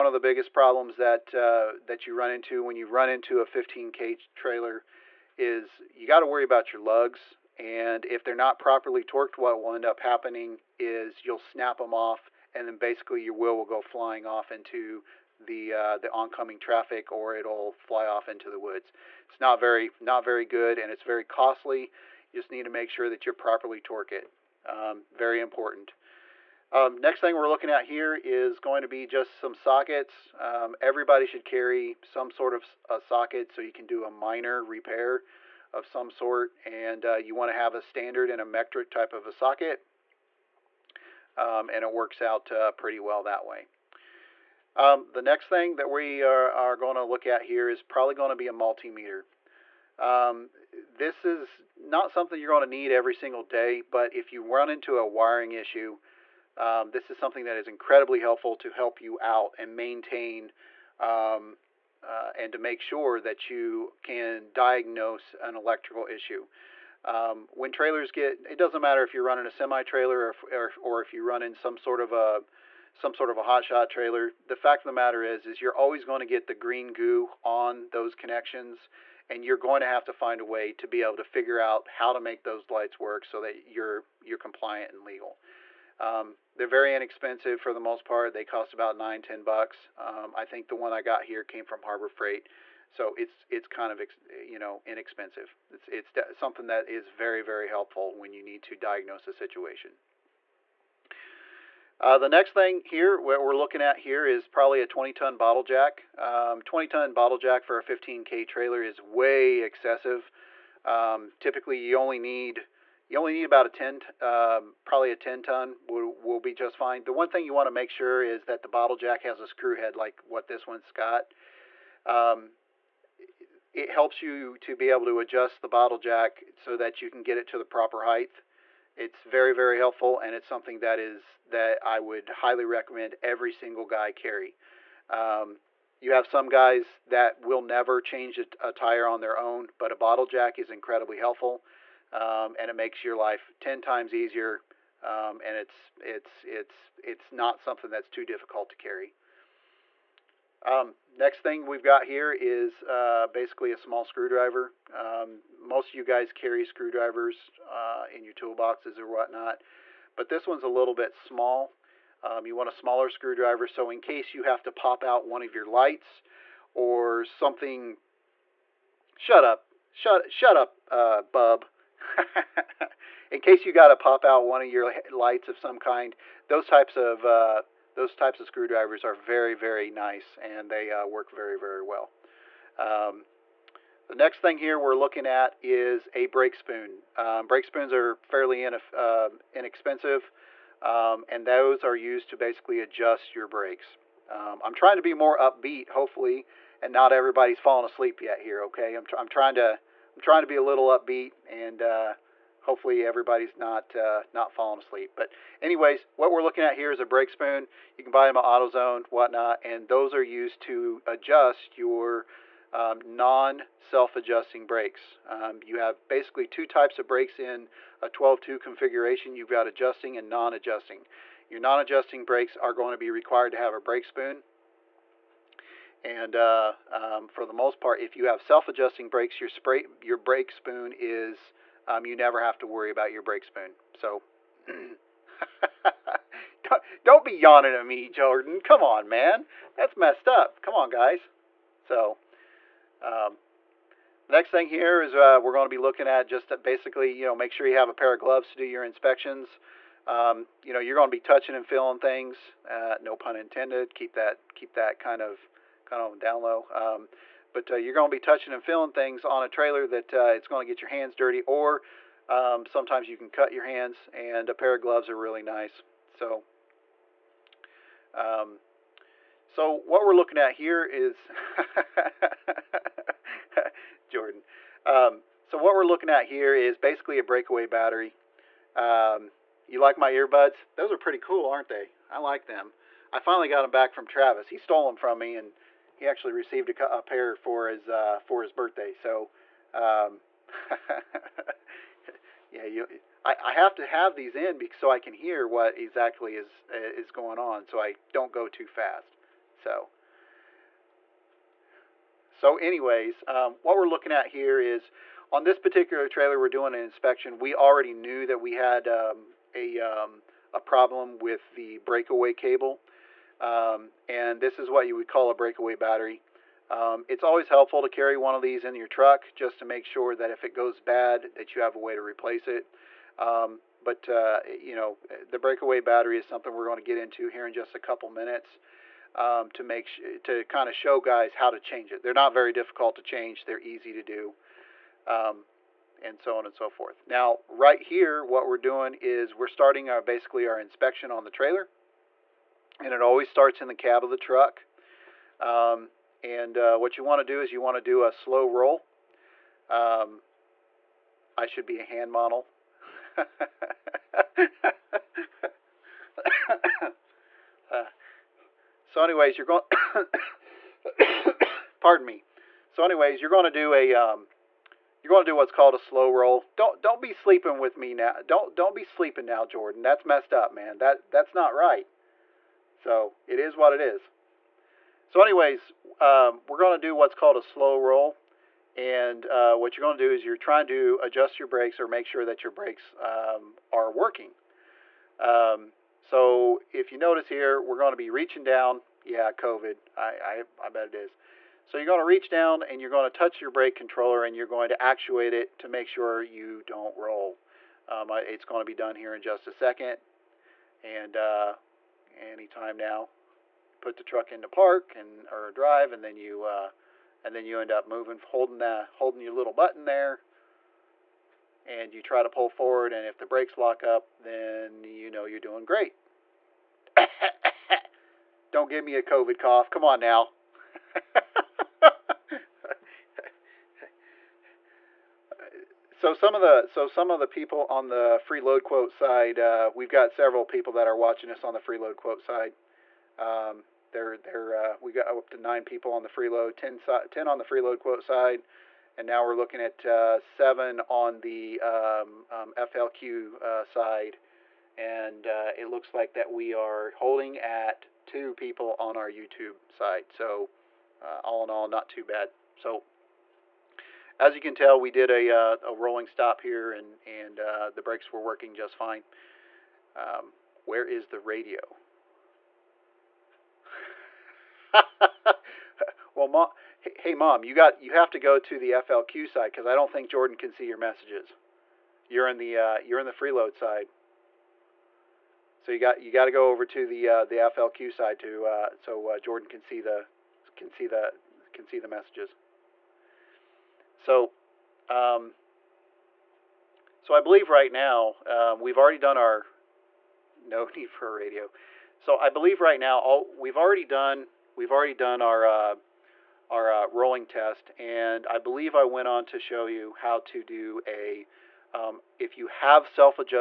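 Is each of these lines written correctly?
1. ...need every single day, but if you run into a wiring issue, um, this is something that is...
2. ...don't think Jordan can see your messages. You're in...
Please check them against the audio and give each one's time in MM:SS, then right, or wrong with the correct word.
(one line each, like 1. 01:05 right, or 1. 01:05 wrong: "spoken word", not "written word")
1. 00:52 right
2. 07:49 right.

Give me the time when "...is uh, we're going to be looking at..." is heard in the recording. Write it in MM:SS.
04:05.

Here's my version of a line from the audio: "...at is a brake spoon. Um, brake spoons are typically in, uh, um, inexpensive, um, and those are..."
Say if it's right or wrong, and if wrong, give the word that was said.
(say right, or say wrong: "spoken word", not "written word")
wrong: "fairly", not "typically".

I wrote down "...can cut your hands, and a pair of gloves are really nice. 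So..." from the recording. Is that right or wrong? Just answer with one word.
right.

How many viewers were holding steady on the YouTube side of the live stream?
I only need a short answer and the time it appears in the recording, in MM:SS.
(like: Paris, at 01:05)
2, at 07:28.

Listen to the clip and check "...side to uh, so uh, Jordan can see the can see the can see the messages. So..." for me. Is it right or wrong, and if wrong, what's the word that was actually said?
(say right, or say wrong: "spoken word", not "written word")
right.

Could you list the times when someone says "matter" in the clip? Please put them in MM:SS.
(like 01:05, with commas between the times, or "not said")
01:08, 01:14.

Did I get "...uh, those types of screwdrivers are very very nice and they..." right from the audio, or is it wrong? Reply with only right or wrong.
right.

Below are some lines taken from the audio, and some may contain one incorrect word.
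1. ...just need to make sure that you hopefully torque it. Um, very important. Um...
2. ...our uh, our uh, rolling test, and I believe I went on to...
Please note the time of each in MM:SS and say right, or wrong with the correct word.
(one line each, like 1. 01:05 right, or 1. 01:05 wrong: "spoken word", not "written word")
1. 00:22 wrong: "properly", not "hopefully"
2. 08:15 right.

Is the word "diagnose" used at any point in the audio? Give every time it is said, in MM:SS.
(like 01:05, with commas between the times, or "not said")
01:04, 01:38.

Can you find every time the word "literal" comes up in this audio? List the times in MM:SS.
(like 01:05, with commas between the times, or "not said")
not said.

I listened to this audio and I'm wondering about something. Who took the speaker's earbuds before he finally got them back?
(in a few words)
Travis.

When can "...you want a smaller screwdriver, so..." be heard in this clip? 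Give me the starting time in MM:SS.
02:42.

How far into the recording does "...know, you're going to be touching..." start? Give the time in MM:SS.
04:10.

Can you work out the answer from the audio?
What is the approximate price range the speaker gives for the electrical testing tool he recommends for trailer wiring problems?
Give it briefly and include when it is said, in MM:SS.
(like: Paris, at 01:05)
9 to 10 dollars, at 01:28.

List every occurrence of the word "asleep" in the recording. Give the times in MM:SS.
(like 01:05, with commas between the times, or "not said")
03:17, 03:24.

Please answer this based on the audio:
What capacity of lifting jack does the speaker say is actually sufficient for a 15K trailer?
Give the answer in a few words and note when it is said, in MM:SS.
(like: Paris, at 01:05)
10 ton, at 01:55.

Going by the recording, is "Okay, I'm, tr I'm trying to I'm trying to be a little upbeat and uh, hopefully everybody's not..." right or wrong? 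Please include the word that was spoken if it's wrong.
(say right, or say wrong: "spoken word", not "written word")
right.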